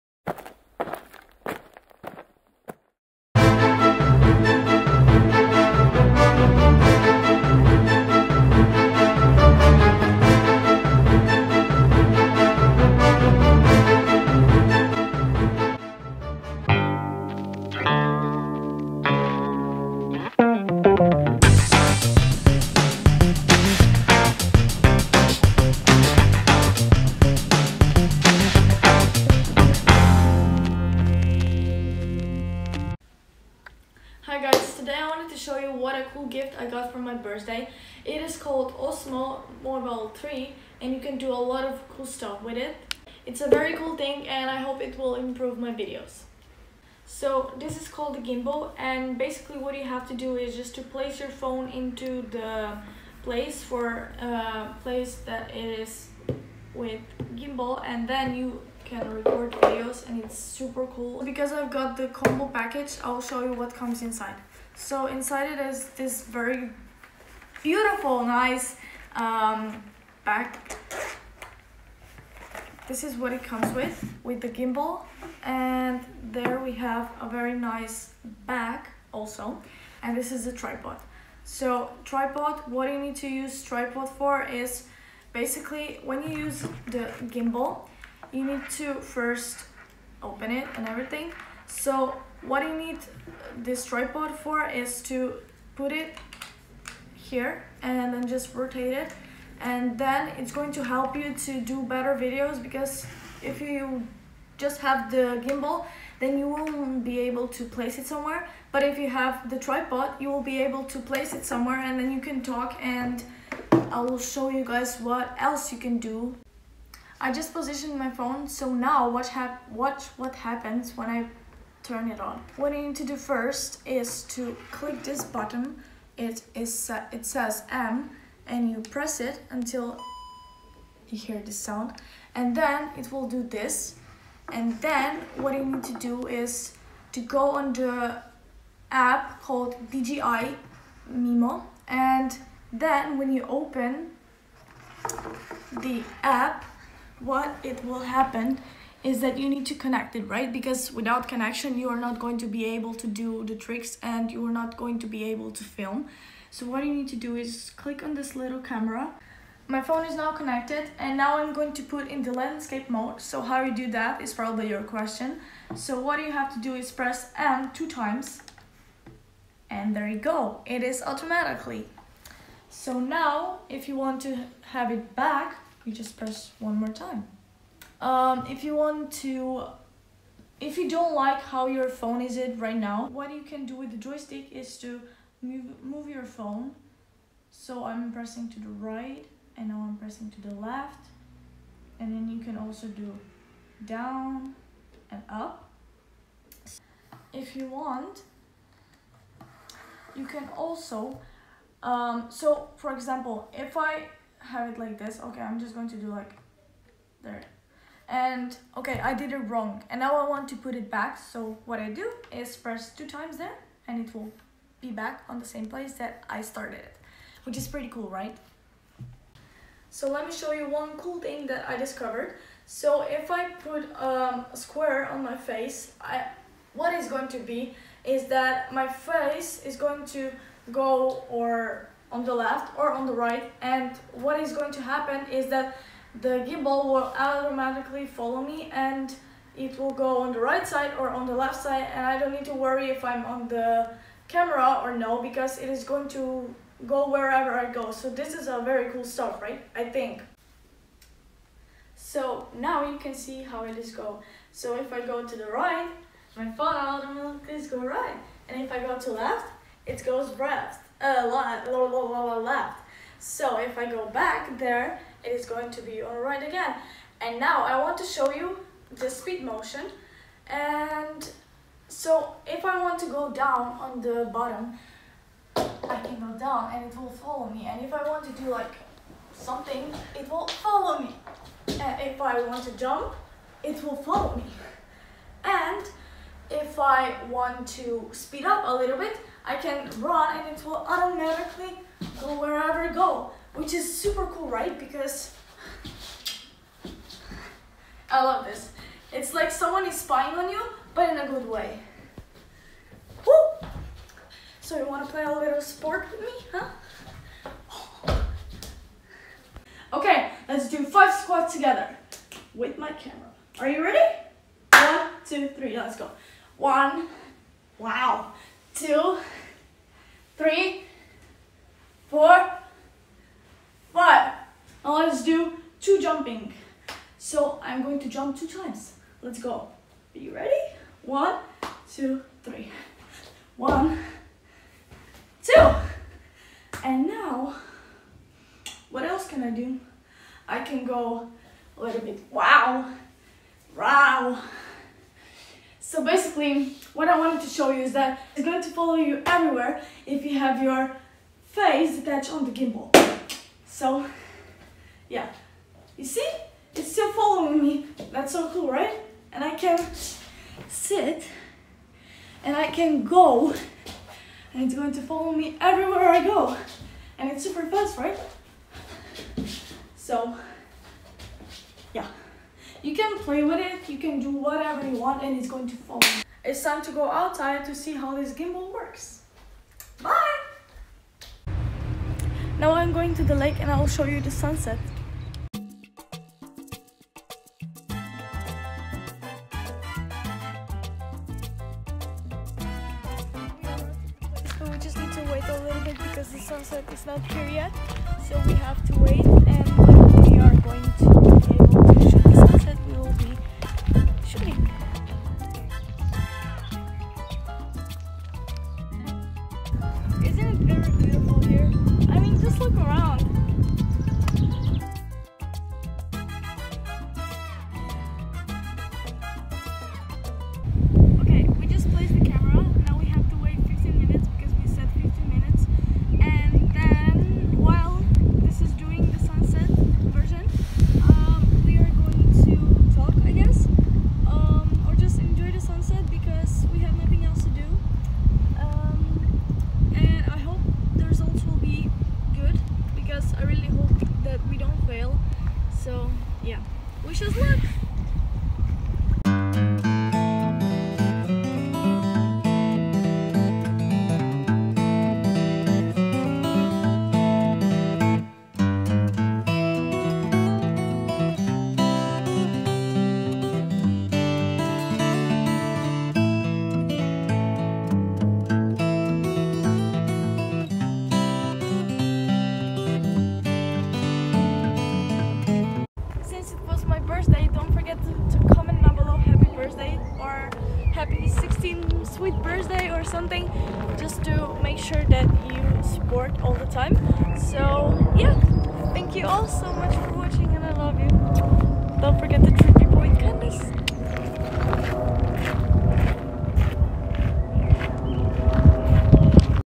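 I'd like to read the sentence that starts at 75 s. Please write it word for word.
And there we have a very nice bag also.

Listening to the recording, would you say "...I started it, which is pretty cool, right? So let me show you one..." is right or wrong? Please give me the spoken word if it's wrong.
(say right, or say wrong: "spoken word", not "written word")
right.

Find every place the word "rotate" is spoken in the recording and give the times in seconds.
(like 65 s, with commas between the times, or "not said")
98 s.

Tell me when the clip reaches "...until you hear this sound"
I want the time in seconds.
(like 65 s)
129 s.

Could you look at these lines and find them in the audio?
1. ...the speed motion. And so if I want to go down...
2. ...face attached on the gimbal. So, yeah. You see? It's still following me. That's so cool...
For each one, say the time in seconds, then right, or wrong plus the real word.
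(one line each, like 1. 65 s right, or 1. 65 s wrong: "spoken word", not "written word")
1. 268 s right
2. 351 s right.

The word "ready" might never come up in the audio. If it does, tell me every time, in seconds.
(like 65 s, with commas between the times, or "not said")
313 s, 330 s.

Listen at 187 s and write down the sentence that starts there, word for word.
So I'm pressing to the right and now I'm pressing to the left.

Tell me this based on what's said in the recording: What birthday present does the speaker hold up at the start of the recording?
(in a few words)
Osmo Mobile 3.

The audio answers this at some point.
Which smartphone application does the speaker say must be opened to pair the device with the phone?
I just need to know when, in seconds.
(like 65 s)
139 s.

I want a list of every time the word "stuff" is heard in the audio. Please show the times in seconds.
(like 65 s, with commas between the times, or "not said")
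42 s, 249 s.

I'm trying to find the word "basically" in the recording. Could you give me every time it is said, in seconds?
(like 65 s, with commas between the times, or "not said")
49 s, 85 s, 346 s.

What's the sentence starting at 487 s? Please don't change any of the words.
So yeah, thank you all so much for watching and I love you.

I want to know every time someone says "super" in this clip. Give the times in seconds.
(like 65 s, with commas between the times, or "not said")
60 s, 293 s, 367 s.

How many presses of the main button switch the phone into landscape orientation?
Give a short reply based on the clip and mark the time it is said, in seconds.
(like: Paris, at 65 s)
2, at 166 s.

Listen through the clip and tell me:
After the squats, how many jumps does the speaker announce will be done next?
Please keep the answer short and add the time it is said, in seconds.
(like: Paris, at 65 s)
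2, at 328 s.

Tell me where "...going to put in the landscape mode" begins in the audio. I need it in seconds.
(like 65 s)
161 s.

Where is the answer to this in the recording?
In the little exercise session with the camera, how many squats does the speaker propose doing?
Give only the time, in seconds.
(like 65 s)
310 s.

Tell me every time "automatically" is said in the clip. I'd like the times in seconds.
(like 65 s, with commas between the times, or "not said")
171 s, 237 s, 256 s, 290 s.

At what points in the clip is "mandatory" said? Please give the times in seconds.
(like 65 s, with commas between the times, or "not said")
not said.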